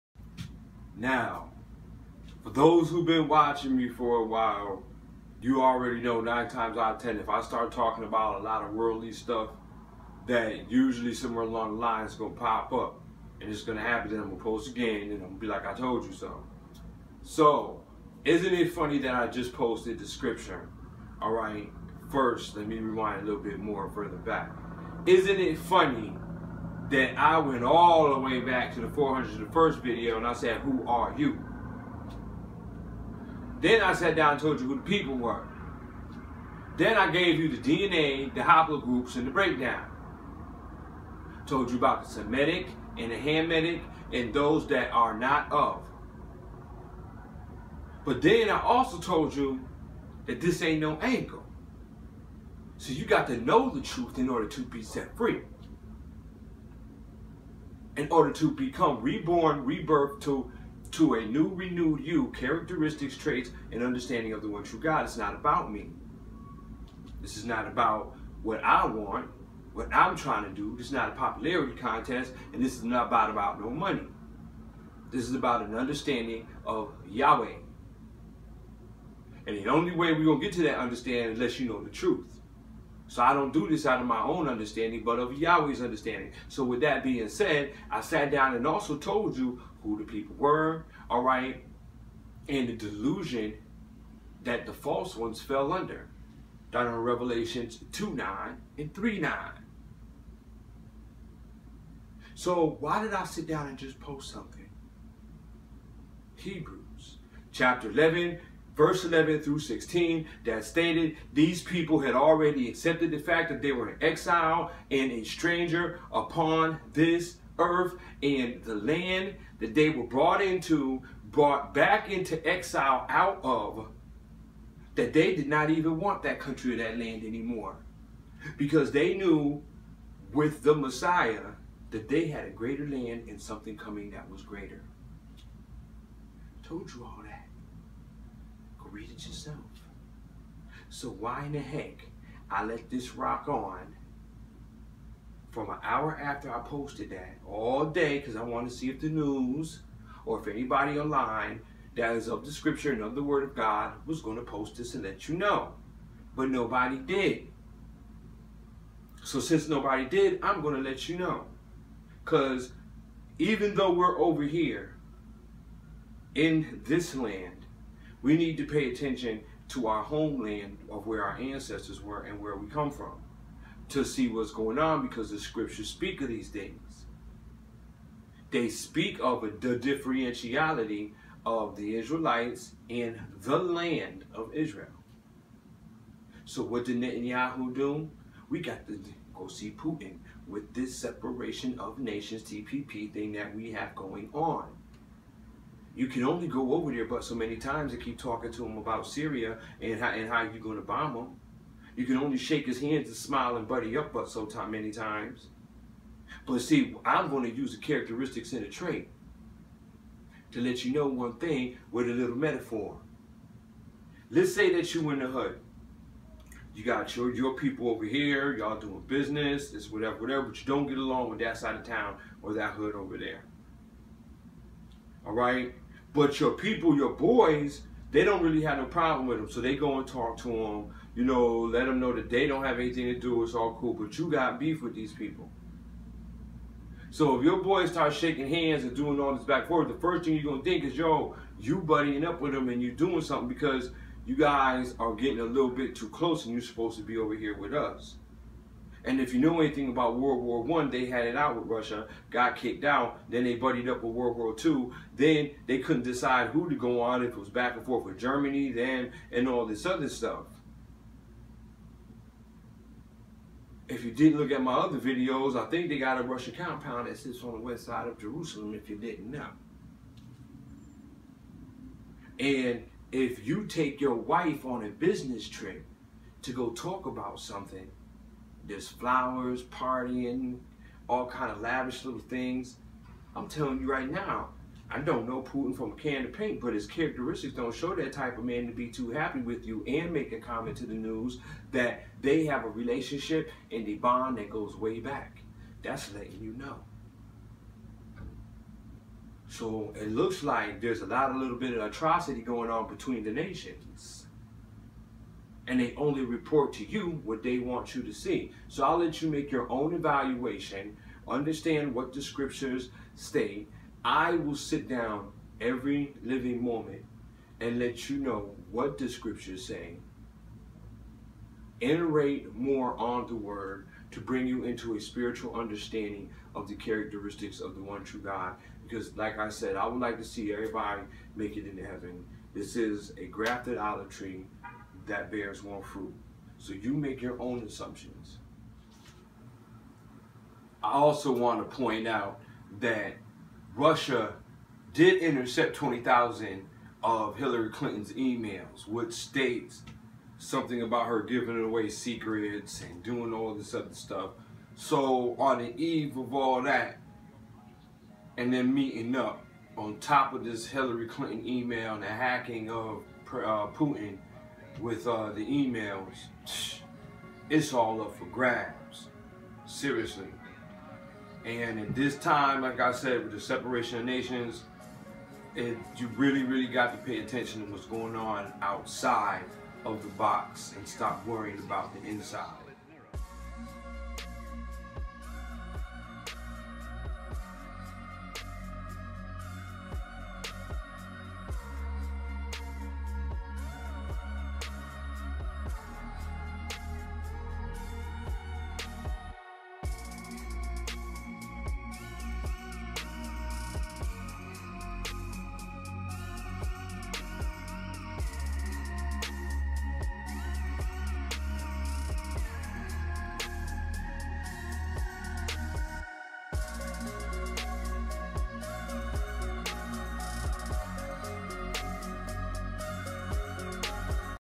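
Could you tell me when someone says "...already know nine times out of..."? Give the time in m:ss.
0:05.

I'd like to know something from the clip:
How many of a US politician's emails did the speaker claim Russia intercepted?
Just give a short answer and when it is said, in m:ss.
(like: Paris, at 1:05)
20,000, at 5:45.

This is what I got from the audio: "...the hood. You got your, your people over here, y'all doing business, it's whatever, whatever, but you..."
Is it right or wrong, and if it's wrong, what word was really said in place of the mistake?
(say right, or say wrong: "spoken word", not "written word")
right.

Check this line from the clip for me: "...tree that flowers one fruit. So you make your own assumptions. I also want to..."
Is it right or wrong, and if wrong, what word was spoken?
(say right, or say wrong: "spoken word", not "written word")
wrong: "bears", not "flowers".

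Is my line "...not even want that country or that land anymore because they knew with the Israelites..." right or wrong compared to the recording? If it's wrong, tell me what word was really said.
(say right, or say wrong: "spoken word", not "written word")
wrong: "Messiah", not "Israelites".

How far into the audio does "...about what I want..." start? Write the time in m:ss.
1:07.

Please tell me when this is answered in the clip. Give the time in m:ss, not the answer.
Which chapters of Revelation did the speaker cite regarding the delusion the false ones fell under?
1:36.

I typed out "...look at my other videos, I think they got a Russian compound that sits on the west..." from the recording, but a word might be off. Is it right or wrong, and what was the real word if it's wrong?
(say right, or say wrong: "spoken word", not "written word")
right.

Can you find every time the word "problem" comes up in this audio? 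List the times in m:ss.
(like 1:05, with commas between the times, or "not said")
3:48.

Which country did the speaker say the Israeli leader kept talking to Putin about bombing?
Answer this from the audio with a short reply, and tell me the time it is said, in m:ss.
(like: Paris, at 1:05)
Syria, at 3:19.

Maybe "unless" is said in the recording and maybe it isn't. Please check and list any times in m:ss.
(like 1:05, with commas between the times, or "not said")
1:21.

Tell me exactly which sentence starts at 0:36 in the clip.
Then I gave you the DNA, the haplogroups, and the breakdown.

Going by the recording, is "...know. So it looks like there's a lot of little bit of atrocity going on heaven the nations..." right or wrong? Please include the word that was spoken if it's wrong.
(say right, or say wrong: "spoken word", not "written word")
wrong: "between", not "heaven".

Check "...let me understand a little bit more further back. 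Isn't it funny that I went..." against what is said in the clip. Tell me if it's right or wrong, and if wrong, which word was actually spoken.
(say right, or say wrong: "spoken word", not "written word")
wrong: "rewind", not "understand".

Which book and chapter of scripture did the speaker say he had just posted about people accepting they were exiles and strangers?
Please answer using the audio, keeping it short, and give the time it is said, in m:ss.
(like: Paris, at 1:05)
Hebrews chapter 11, at 1:46.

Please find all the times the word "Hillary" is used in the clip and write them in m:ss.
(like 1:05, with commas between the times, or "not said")
5:47, 6:00.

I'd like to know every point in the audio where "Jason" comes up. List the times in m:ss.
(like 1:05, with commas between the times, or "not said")
not said.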